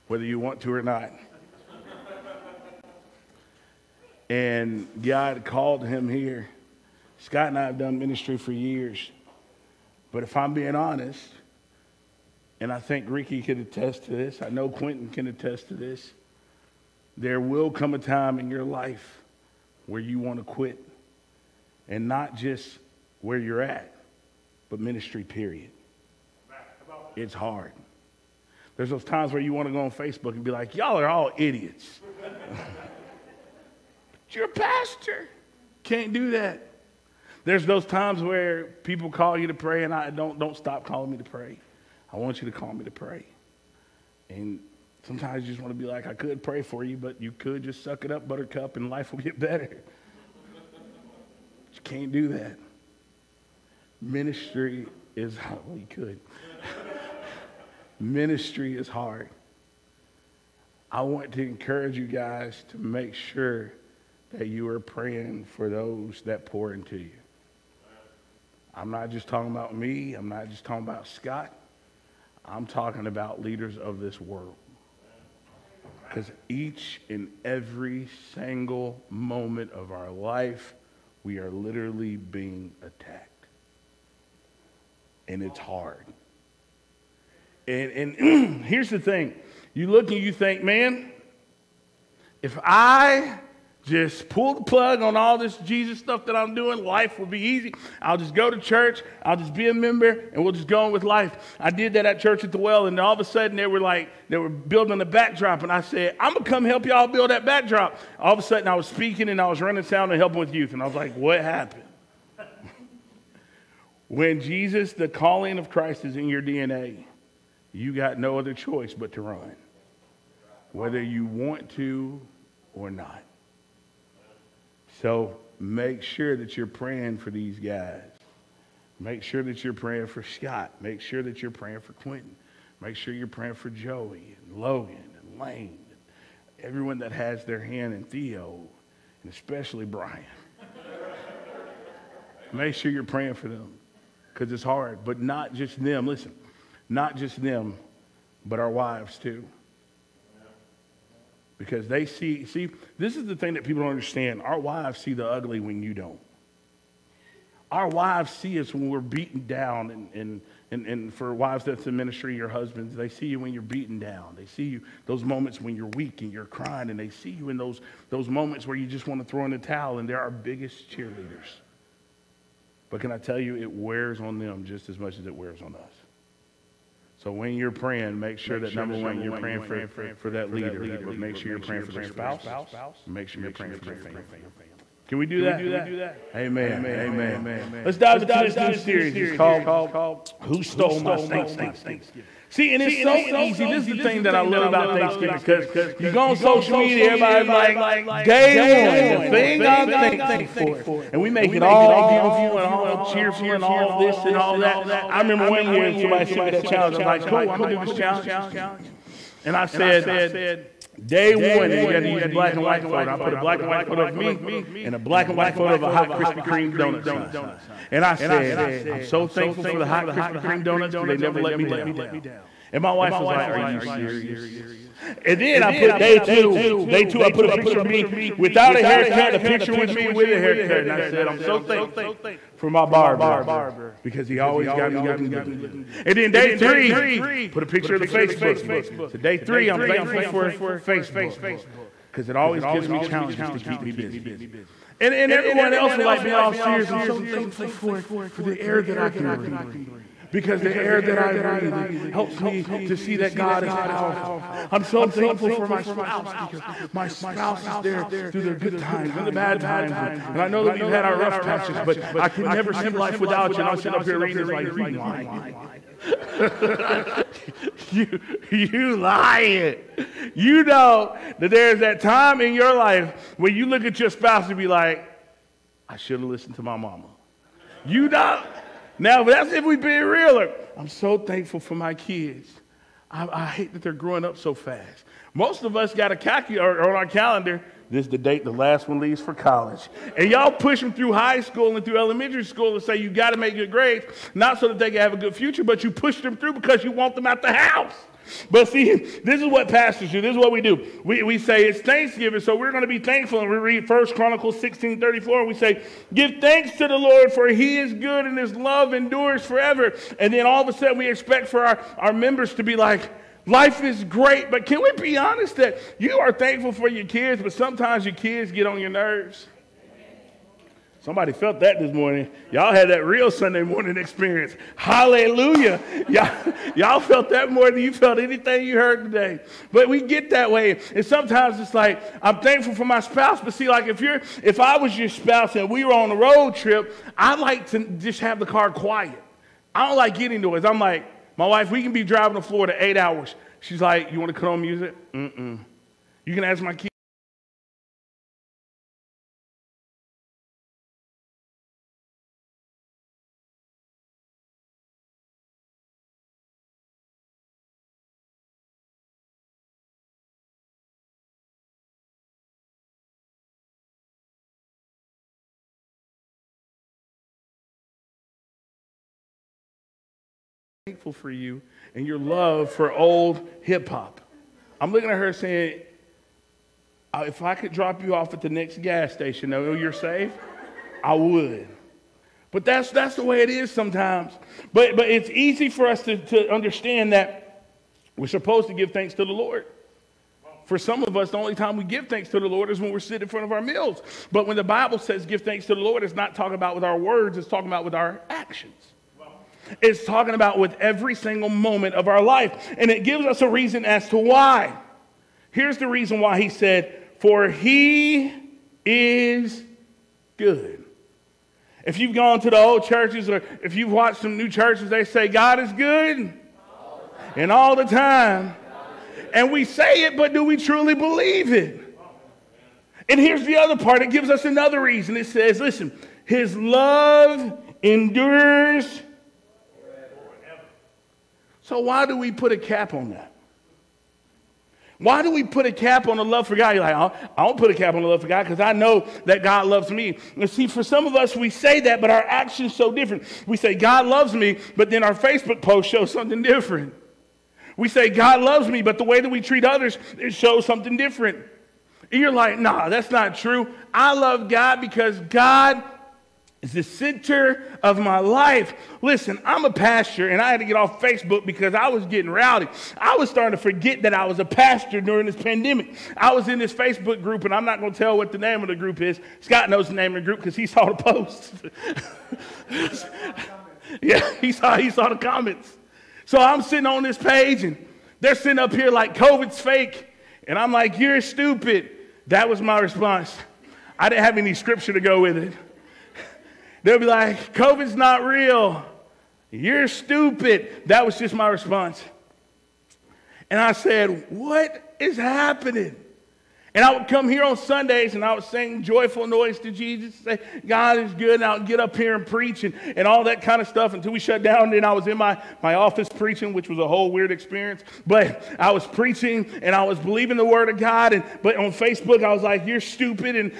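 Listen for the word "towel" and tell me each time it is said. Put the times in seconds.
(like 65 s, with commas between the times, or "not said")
169 s.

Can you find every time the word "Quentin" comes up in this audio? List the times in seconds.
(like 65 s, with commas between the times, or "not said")
14 s, 131 s.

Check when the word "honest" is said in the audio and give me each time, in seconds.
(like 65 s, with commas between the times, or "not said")
10 s, 315 s.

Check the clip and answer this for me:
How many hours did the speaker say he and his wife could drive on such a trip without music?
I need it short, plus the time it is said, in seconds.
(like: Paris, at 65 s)
8, at 342 s.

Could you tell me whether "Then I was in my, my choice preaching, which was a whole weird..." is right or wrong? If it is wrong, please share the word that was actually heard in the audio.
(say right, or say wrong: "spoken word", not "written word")
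wrong: "office", not "choice".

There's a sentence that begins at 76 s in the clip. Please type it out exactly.
Because each and every single moment of our life we are literally being attacked.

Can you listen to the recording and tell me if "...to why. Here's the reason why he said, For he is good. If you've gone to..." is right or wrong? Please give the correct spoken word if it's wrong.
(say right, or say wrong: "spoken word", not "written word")
right.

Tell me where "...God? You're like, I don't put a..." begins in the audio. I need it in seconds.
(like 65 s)
436 s.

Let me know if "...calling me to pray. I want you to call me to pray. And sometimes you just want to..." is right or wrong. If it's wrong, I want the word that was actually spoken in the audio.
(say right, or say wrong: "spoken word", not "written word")
right.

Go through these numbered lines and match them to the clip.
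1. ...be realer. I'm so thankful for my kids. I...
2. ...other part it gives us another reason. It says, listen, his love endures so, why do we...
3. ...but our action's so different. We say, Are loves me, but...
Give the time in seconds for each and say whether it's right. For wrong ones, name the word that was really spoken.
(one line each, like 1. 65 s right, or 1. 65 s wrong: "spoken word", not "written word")
1. 279 s right
2. 423 s right
3. 442 s wrong: "God", not "Are".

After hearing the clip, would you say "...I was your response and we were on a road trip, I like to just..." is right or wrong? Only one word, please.
wrong.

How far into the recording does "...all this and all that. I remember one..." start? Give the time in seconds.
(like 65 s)
203 s.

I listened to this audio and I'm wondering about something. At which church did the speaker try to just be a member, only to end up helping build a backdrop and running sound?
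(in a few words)
Church at the Well.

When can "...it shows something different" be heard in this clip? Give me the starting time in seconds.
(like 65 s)
450 s.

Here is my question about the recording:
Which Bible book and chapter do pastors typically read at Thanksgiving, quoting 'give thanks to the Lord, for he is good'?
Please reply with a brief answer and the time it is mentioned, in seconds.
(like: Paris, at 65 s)
1 Chronicles 16, at 303 s.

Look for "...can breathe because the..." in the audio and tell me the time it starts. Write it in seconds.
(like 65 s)
249 s.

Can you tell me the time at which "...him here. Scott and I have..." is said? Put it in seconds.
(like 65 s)
5 s.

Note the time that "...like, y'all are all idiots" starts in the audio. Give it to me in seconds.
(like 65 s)
30 s.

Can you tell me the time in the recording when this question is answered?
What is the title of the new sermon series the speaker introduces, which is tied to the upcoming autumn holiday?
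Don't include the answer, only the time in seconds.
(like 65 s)
190 s.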